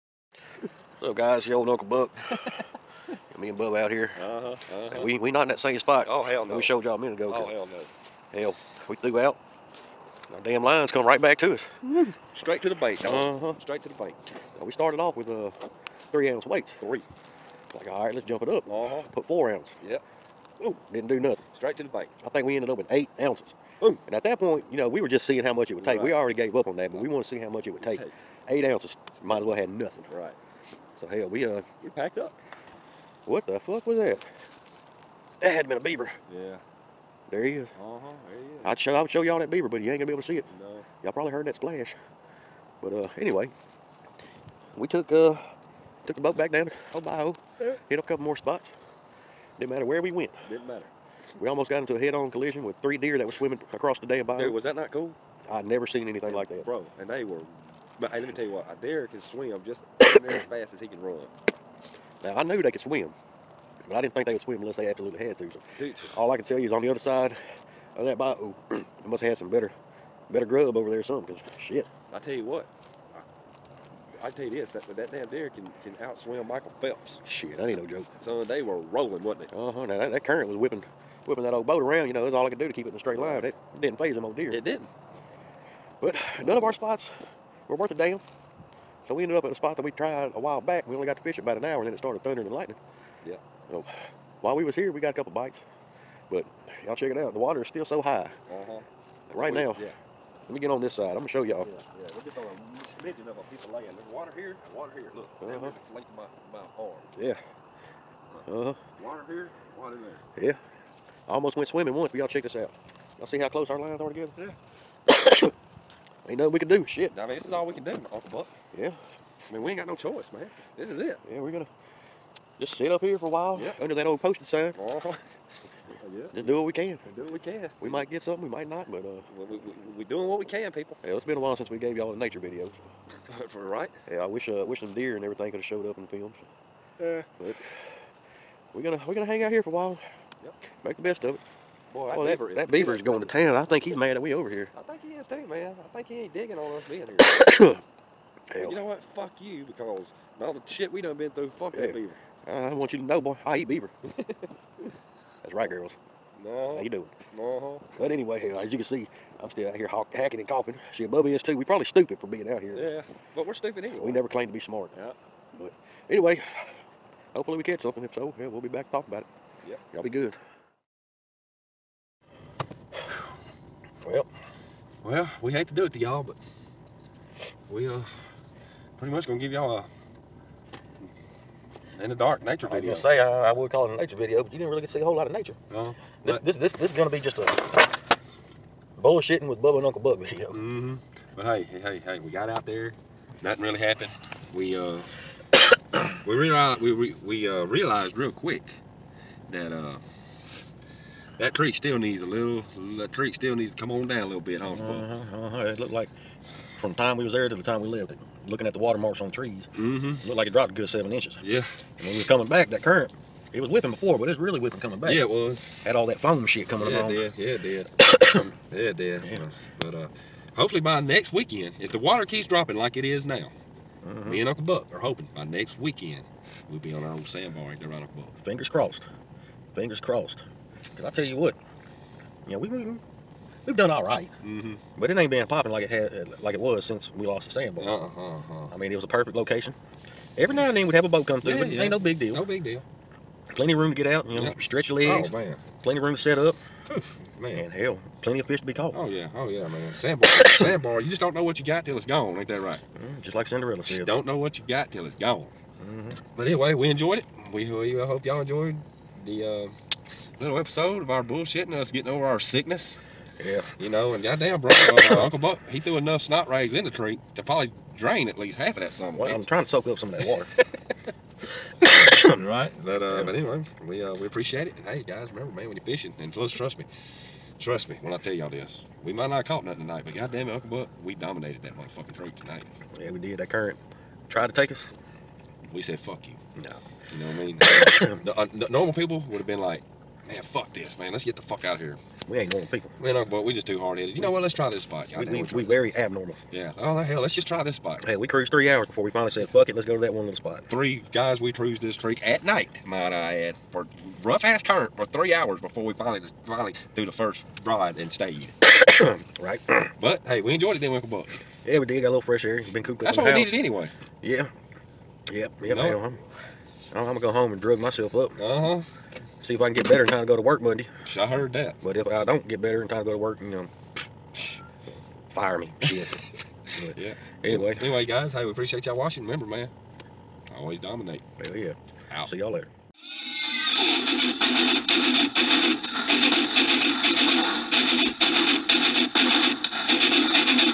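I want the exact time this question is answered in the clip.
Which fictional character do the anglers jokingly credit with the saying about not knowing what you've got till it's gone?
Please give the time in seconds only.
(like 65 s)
253 s.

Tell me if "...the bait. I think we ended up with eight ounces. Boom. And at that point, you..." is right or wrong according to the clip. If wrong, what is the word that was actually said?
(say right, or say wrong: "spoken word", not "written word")
right.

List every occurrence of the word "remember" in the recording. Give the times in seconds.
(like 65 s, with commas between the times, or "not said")
275 s, 329 s.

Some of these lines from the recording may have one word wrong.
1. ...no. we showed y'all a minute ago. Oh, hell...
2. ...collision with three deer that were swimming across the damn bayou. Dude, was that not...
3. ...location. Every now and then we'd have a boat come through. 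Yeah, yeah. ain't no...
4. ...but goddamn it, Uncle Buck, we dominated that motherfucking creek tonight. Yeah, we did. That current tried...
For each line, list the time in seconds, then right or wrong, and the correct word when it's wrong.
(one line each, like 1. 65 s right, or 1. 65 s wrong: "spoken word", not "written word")
1. 6 s right
2. 52 s right
3. 239 s right
4. 280 s right.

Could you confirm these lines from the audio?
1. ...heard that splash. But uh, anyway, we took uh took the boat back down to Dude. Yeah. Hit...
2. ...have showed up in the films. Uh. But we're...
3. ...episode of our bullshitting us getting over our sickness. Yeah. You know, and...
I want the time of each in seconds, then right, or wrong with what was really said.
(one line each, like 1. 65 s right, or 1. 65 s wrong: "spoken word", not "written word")
1. 41 s wrong: "Ohio", not "Dude"
2. 135 s right
3. 260 s right.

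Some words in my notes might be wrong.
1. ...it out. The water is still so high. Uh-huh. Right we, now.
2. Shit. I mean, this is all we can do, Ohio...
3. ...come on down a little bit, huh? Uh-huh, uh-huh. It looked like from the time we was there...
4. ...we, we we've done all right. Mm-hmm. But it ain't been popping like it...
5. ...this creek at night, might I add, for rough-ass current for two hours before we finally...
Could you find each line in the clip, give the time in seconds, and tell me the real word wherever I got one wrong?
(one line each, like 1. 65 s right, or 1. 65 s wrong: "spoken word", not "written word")
1. 97 s right
2. 116 s wrong: "Uncle", not "Ohio"
3. 203 s right
4. 232 s right
5. 301 s wrong: "three", not "two".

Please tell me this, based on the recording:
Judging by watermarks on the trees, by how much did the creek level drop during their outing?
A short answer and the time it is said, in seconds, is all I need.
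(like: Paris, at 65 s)
7 inches, at 210 s.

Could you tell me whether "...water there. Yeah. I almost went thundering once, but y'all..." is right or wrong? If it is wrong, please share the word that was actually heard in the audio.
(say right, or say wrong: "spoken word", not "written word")
wrong: "swimming", not "thundering".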